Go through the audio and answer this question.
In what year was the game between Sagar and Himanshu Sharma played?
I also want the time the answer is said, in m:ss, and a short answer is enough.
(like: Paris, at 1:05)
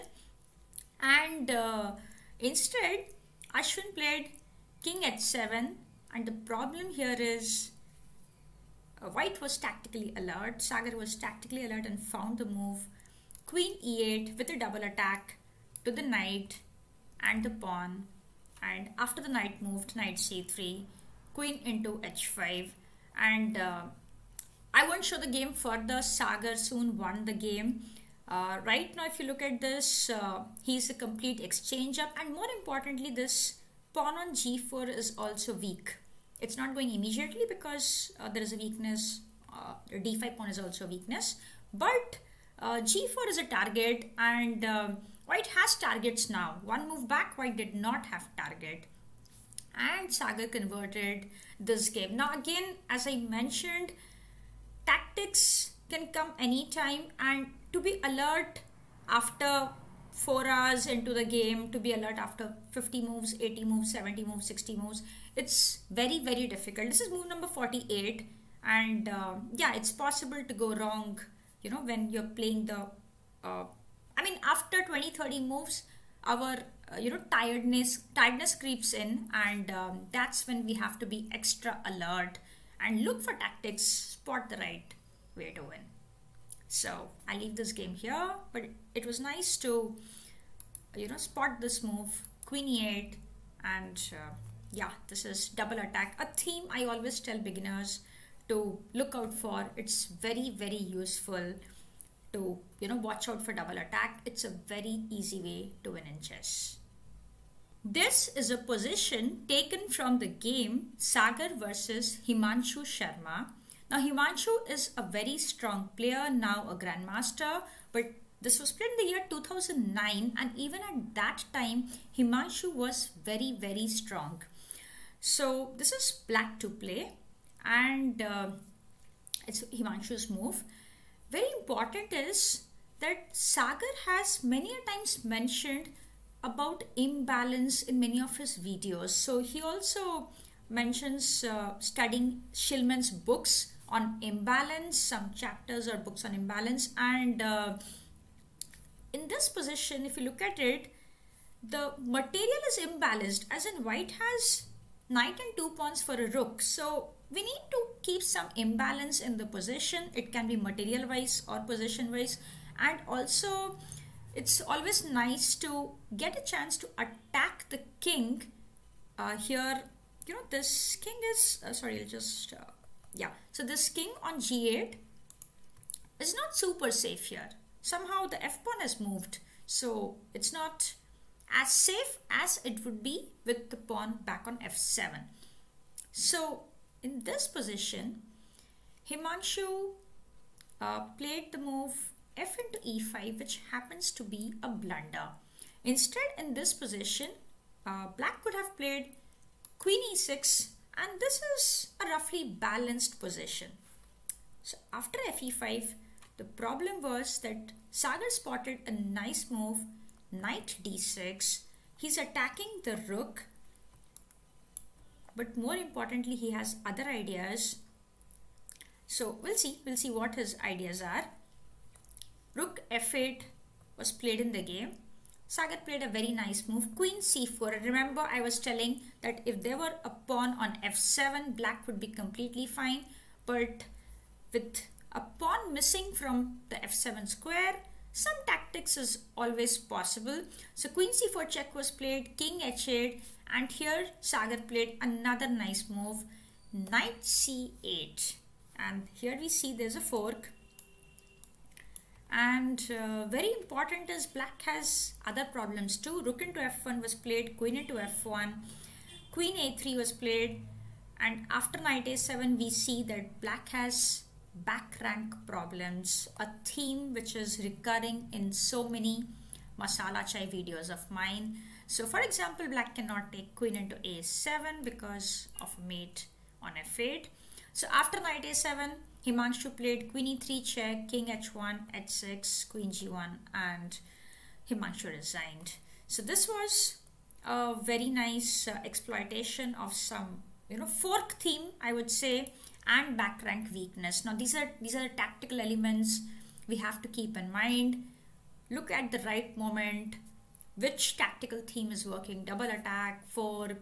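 2009, at 1:59.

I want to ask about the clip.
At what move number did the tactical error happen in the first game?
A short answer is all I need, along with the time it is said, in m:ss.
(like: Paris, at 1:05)
48, at 1:07.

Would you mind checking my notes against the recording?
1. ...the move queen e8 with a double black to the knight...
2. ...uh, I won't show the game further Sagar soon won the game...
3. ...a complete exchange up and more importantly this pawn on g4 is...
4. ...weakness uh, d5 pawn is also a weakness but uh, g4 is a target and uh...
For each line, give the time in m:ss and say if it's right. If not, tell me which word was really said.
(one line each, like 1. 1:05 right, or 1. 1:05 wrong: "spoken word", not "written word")
1. 0:12 wrong: "attack", not "black"
2. 0:23 right
3. 0:30 right
4. 0:38 right.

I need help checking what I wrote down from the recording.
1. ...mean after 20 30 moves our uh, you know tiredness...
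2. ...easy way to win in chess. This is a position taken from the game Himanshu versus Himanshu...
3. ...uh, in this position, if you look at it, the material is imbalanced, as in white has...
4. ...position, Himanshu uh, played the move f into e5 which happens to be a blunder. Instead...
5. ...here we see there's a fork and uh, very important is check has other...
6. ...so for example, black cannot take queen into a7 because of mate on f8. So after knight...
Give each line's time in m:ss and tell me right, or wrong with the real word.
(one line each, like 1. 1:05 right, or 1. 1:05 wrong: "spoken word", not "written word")
1. 1:14 right
2. 1:45 wrong: "Sagar", not "Himanshu"
3. 2:27 right
4. 3:07 right
5. 4:09 wrong: "black", not "check"
6. 4:31 right.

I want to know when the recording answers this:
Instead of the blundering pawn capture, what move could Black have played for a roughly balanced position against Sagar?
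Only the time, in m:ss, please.
3:19.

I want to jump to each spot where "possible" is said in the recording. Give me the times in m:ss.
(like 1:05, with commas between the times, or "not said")
1:09, 3:59.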